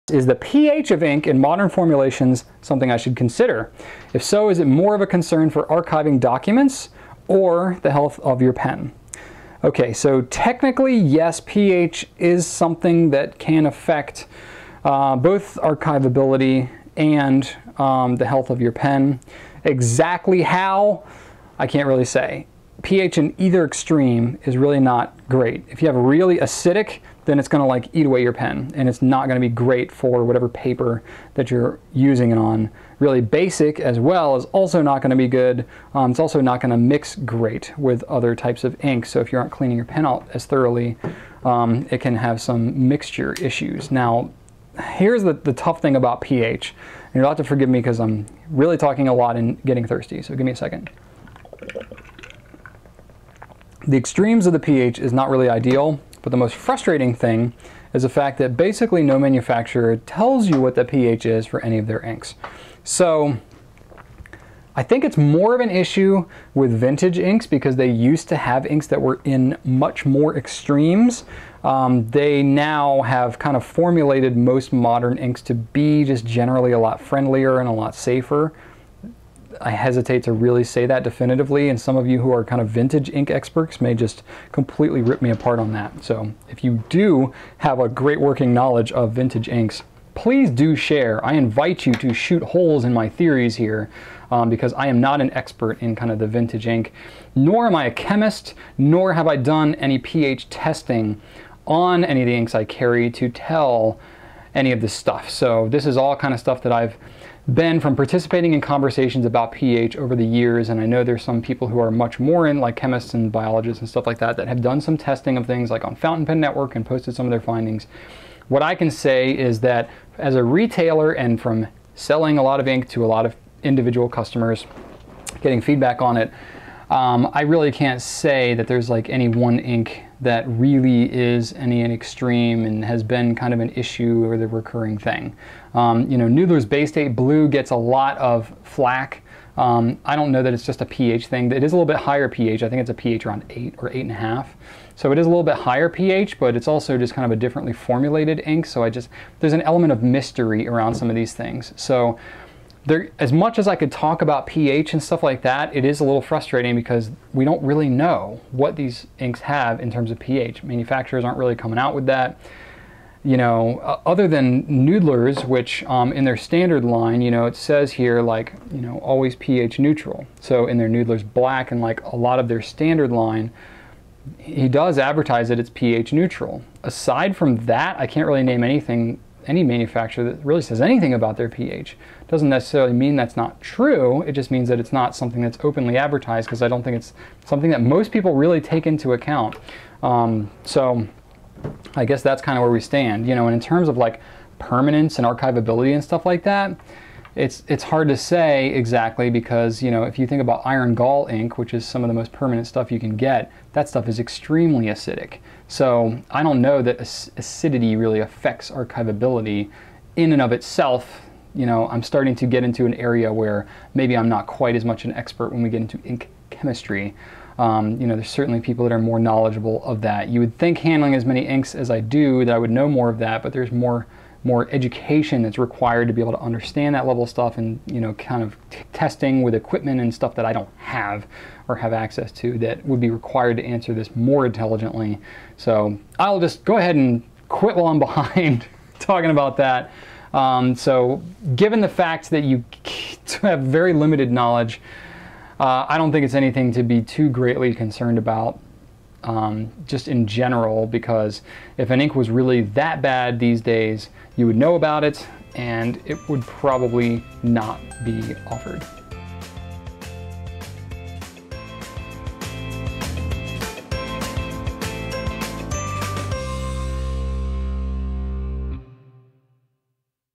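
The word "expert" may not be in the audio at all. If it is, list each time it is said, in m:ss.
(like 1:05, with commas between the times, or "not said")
1:23, 1:35, 3:35.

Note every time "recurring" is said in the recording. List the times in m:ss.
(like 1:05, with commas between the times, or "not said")
2:14.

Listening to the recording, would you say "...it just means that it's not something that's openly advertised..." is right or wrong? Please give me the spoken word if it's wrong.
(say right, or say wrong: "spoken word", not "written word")
right.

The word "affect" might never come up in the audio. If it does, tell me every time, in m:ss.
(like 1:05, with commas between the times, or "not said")
0:13, 3:28.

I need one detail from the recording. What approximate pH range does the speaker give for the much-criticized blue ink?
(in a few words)
8 or 8.5.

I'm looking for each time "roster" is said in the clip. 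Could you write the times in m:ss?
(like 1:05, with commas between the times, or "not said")
not said.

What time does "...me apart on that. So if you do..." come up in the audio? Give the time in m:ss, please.
1:25.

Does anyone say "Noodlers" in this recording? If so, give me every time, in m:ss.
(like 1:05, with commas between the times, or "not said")
2:16, 2:44, 2:50.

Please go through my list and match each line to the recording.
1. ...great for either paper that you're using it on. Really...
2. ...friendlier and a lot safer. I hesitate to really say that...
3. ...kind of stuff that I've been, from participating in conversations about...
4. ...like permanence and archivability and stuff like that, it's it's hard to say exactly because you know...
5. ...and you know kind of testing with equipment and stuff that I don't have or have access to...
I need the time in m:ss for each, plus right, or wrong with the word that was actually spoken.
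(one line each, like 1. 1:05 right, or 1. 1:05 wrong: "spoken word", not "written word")
1. 0:29 wrong: "whatever", not "either"
2. 1:17 right
3. 1:46 right
4. 3:13 right
5. 3:47 right.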